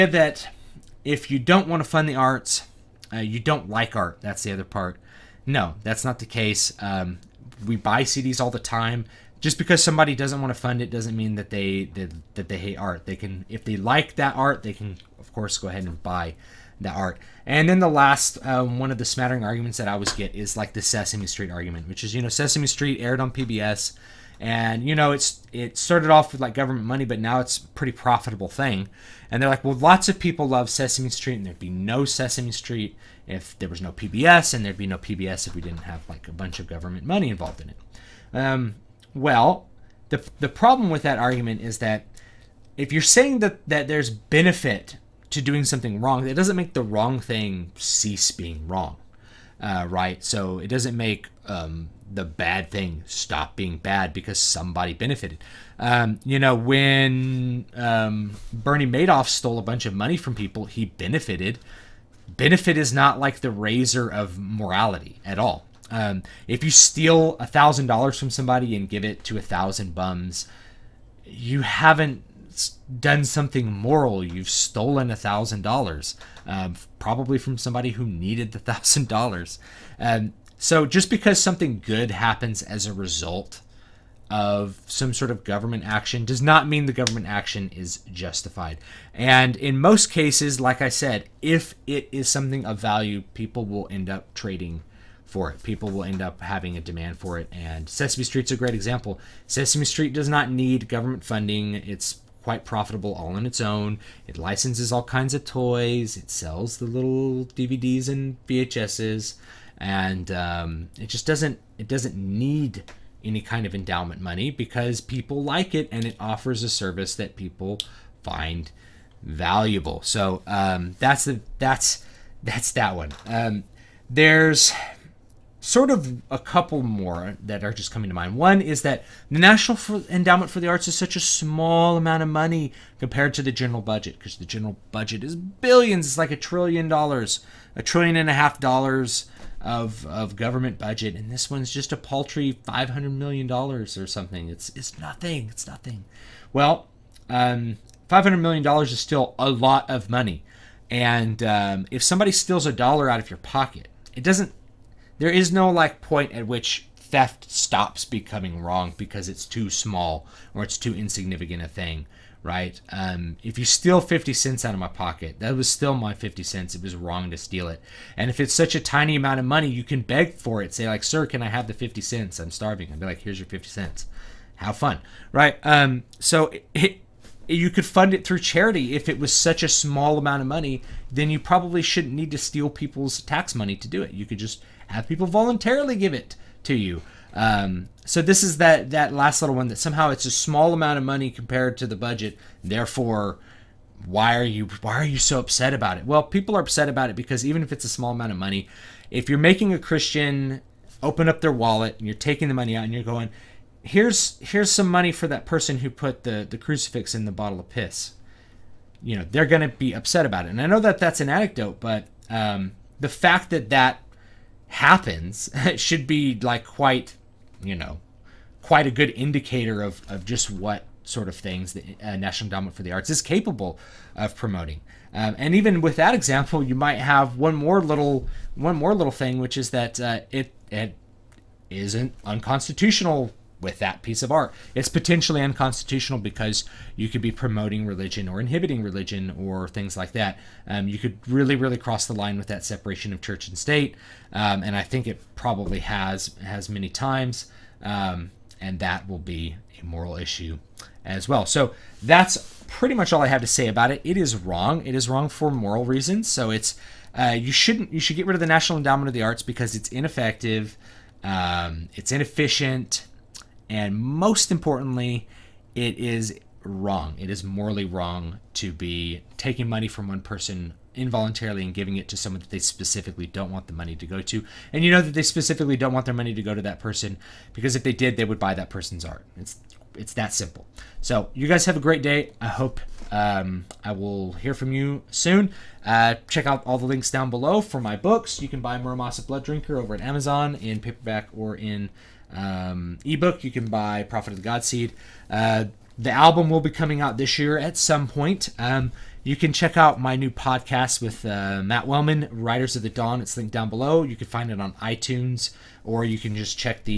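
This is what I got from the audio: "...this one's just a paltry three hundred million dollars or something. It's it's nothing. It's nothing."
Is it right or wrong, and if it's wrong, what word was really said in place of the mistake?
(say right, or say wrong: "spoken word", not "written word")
wrong: "five", not "three".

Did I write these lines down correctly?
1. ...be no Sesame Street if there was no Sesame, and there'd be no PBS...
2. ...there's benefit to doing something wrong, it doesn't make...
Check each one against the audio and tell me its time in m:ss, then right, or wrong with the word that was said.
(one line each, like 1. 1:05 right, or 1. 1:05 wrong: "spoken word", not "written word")
1. 0:31 wrong: "PBS", not "Sesame"
2. 0:43 right.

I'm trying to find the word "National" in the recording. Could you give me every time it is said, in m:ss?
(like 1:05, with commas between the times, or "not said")
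2:09, 3:42, 4:18.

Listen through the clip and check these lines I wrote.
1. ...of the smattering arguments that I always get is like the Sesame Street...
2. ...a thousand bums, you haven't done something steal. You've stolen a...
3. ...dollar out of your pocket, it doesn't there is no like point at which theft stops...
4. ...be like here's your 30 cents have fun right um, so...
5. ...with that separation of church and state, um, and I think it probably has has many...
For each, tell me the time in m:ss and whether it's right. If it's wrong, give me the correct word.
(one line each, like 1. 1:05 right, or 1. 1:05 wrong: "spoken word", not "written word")
1. 0:18 right
2. 1:09 wrong: "moral", not "steal"
3. 2:32 right
4. 2:53 wrong: "50", not "30"
5. 4:02 right.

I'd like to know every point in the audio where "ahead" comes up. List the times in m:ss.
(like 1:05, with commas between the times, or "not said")
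0:15.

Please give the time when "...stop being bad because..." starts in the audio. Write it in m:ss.
0:53.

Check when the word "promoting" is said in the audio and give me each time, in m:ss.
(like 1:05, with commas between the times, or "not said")
3:44, 3:57.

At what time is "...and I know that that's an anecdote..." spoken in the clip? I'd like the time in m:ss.
3:30.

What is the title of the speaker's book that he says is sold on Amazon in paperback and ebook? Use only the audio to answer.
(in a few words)
Muramasa Blood Drinker.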